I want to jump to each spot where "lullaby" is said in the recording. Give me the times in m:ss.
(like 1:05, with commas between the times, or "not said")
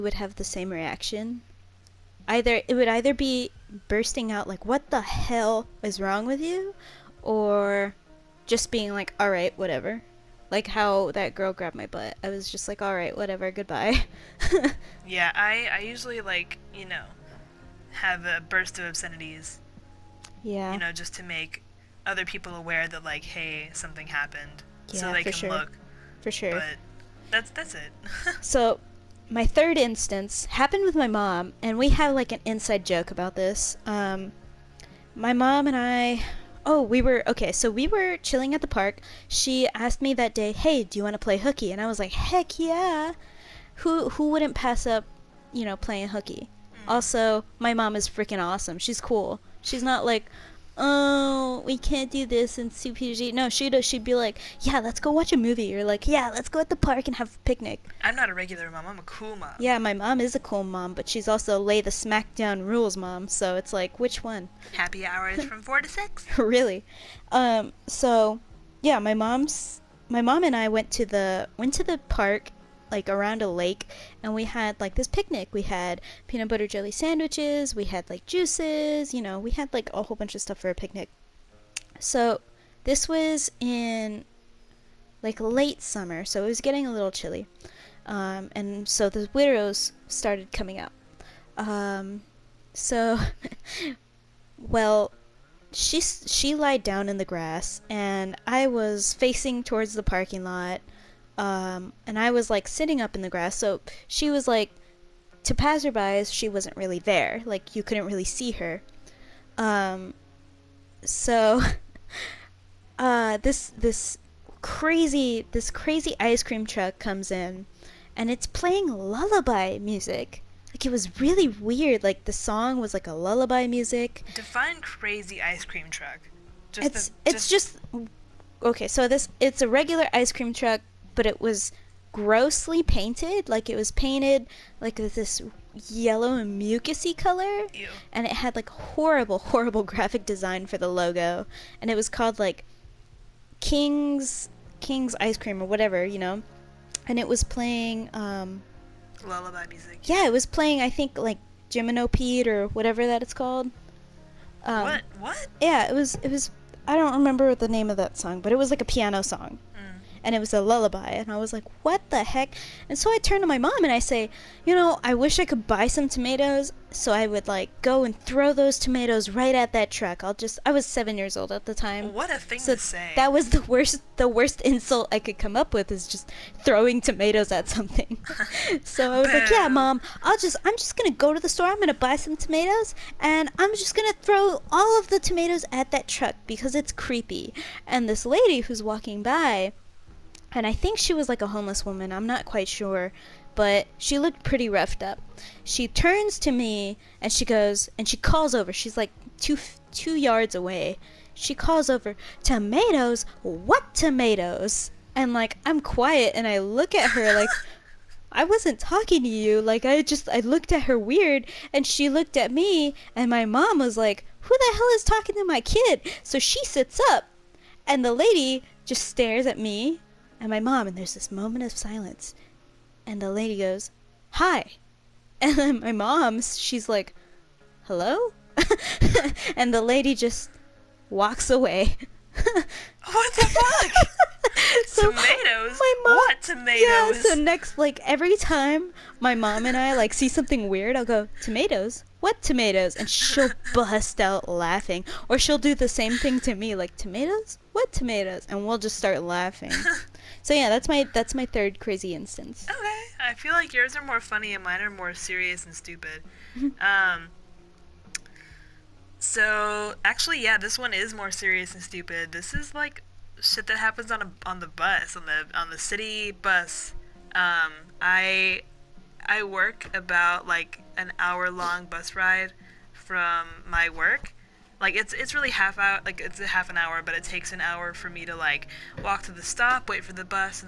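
1:58, 2:03, 2:29, 2:40.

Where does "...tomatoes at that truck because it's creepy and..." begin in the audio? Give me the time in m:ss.
3:05.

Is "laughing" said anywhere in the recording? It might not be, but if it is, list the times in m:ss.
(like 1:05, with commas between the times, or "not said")
4:04, 4:09.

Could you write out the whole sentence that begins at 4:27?
Um, I I work about like an hour long bus ride from my work.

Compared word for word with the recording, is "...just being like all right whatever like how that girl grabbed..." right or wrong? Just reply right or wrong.
right.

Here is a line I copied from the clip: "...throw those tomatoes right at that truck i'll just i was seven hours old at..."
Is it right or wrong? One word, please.
wrong.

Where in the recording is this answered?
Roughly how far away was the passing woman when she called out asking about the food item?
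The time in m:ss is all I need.
3:19.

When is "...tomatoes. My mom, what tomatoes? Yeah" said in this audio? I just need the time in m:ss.
3:55.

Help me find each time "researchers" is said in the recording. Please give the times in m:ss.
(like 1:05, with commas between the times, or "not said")
not said.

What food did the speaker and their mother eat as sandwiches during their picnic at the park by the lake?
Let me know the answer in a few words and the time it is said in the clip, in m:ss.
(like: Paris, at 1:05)
Peanut butter jelly, at 1:16.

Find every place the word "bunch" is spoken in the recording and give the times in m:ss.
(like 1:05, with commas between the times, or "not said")
1:20.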